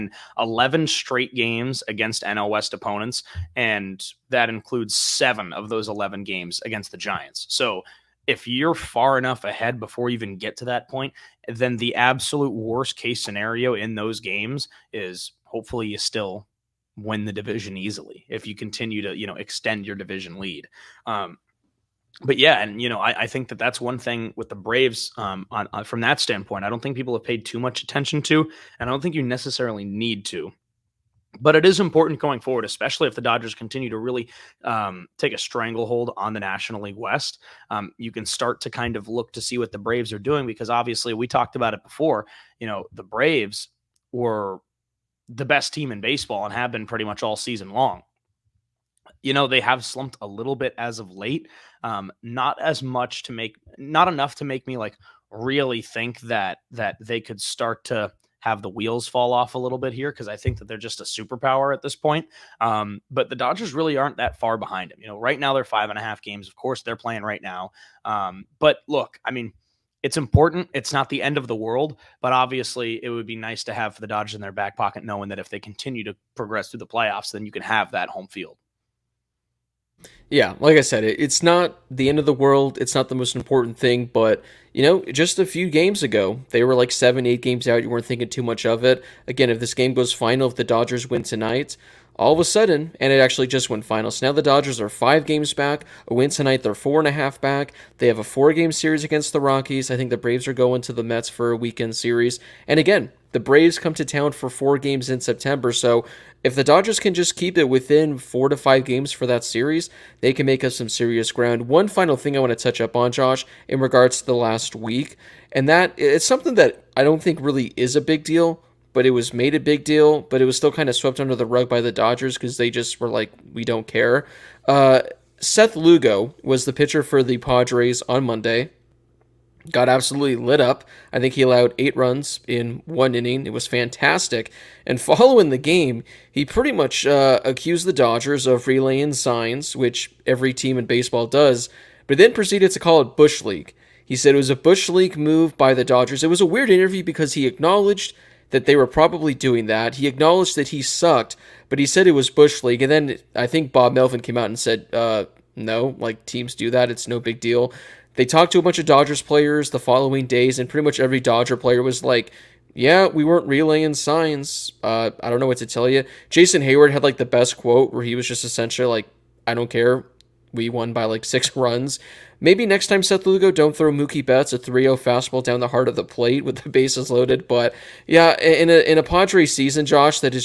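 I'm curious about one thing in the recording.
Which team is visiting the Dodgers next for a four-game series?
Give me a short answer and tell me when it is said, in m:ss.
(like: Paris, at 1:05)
Rockies, at 1:39.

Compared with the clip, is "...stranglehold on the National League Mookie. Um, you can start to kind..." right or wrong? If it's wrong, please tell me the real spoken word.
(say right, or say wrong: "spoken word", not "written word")
wrong: "West", not "Mookie".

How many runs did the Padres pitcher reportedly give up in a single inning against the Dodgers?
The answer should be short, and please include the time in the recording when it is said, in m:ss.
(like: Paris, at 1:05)
8, at 2:11.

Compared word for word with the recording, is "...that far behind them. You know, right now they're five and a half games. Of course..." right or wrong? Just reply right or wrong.
right.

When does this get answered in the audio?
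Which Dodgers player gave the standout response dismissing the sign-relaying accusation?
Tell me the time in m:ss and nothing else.
2:46.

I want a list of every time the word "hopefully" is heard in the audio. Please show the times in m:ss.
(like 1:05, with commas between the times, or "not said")
0:15.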